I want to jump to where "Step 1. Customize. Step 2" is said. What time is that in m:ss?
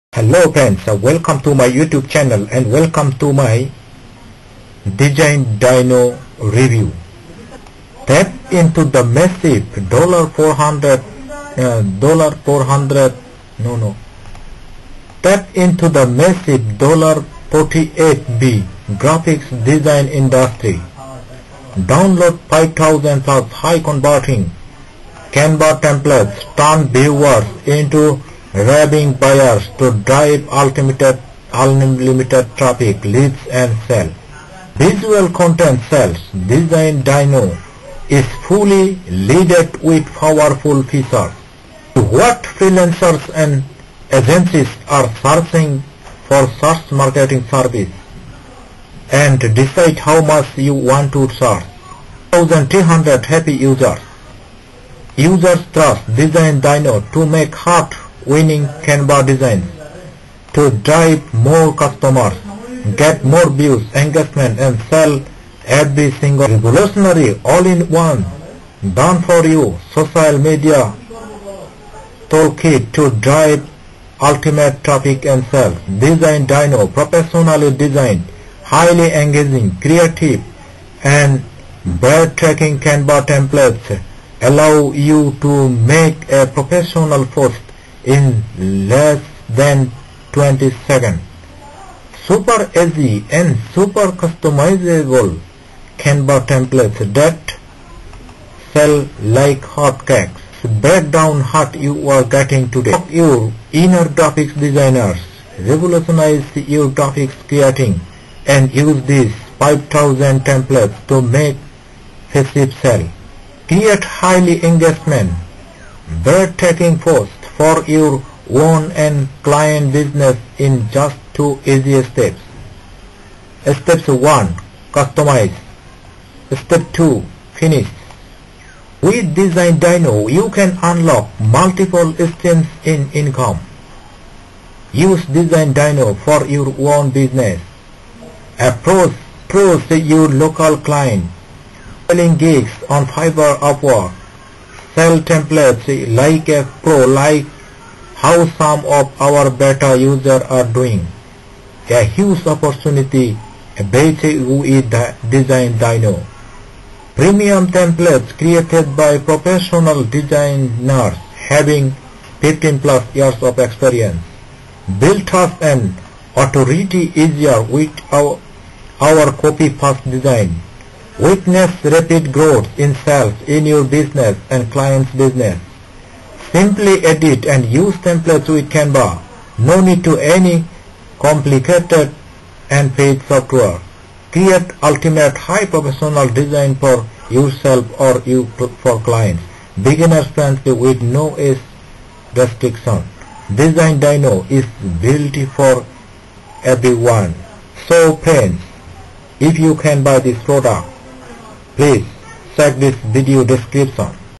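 2:03.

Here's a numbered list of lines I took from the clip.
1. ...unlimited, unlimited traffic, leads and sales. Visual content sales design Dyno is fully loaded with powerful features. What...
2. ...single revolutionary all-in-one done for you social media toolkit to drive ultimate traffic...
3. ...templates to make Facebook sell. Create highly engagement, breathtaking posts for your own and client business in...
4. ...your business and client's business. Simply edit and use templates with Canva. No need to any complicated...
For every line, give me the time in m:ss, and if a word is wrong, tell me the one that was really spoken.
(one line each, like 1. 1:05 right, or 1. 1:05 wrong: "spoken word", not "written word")
1. 0:30 right
2. 1:06 right
3. 1:50 right
4. 2:53 right.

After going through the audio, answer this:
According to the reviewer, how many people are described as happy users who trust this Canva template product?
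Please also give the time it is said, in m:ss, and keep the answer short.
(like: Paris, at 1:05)
1300, at 0:52.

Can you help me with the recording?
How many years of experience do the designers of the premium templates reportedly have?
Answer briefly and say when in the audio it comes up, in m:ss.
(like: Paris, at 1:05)
15 plus years, at 2:42.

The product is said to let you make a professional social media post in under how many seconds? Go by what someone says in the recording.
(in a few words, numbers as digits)
20 seconds.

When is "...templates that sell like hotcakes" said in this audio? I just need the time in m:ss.
1:36.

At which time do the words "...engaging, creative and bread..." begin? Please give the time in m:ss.
1:19.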